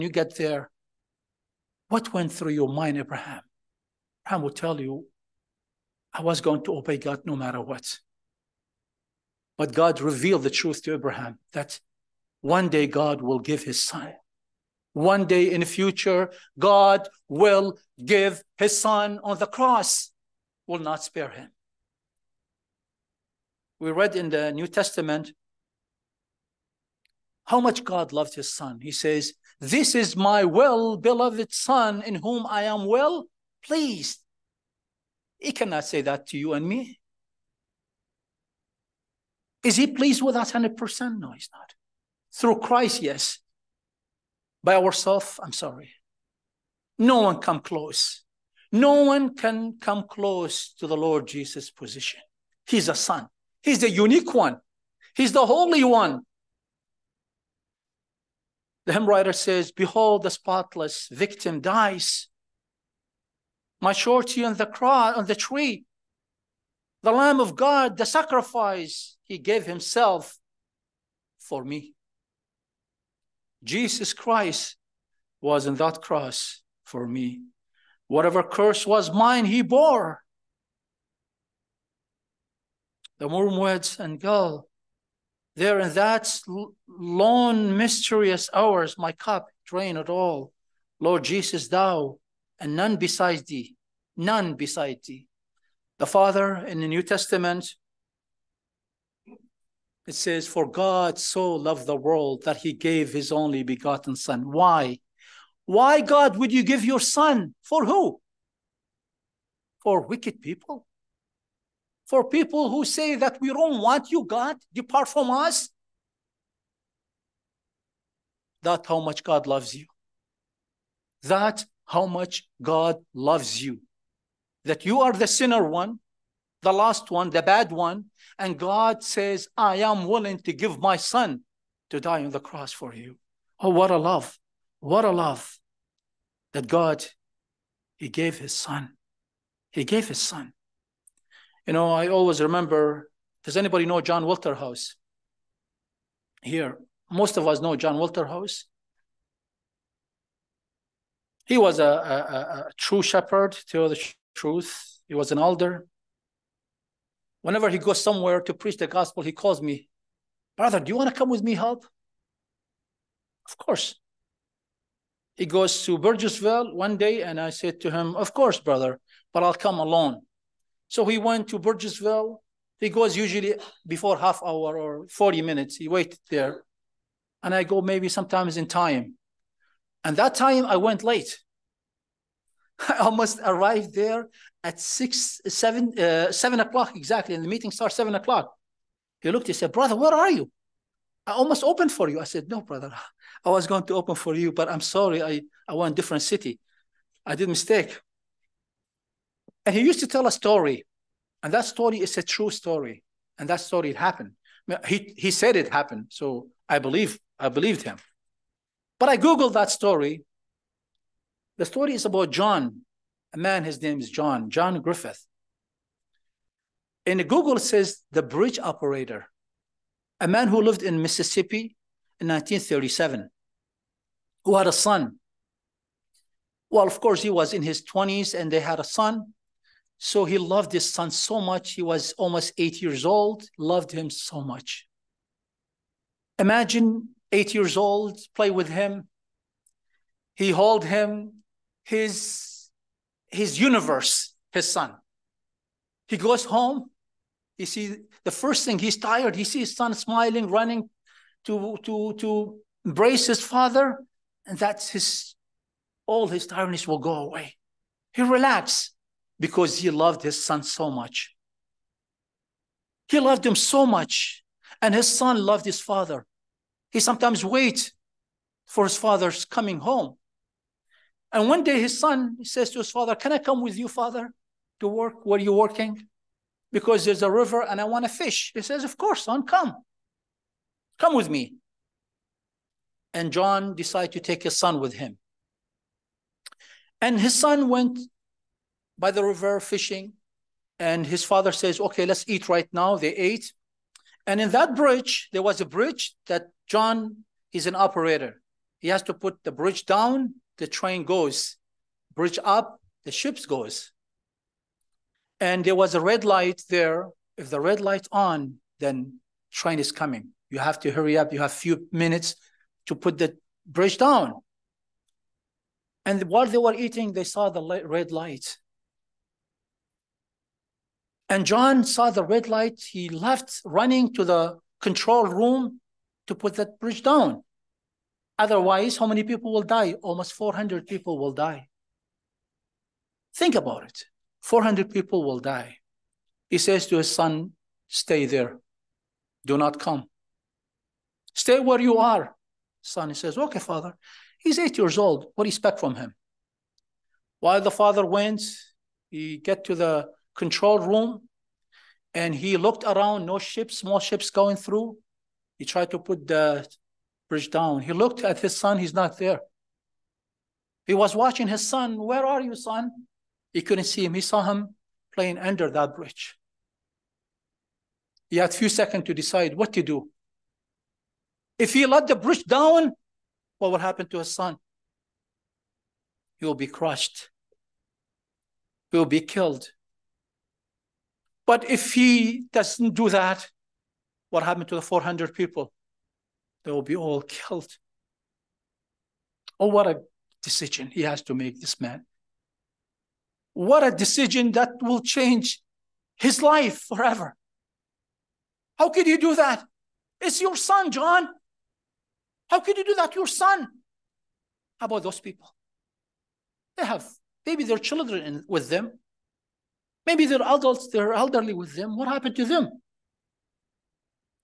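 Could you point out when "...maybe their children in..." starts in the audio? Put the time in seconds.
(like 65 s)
407 s.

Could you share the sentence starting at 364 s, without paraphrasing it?
He saw him playing under that bridge.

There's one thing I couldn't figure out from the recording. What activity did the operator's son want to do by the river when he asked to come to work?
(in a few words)
Fish.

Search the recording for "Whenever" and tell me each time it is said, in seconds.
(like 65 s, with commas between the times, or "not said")
157 s.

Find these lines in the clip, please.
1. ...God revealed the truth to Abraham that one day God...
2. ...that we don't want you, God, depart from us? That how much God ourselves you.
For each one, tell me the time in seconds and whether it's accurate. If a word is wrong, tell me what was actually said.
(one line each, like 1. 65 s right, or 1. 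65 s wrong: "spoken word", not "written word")
1. 9 s right
2. 113 s wrong: "loves", not "ourselves".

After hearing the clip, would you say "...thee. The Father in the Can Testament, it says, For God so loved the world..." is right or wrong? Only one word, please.
wrong.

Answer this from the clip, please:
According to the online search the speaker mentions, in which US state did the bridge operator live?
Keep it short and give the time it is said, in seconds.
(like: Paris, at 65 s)
Mississippi, at 221 s.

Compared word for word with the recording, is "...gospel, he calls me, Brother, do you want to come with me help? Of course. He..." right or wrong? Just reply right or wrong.
right.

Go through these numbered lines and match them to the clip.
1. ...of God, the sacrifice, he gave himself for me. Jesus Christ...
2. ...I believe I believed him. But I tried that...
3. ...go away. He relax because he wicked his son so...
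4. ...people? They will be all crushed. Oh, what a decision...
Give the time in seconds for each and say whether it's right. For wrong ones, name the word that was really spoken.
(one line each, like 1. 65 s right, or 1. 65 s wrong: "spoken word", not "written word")
1. 67 s right
2. 206 s wrong: "googled", not "tried"
3. 256 s wrong: "loved", not "wicked"
4. 385 s wrong: "killed", not "crushed".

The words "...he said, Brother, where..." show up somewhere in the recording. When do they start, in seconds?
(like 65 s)
189 s.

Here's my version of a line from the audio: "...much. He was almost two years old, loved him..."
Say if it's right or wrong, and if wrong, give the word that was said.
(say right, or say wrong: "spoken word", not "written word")
wrong: "eight", not "two".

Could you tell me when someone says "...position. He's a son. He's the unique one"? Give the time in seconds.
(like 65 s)
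51 s.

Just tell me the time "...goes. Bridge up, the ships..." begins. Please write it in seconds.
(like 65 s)
301 s.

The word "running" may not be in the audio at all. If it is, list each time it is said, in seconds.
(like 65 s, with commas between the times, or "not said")
250 s, 323 s.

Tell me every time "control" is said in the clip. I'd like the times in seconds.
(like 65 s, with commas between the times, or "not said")
324 s, 350 s.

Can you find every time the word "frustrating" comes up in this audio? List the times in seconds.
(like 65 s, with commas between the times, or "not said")
not said.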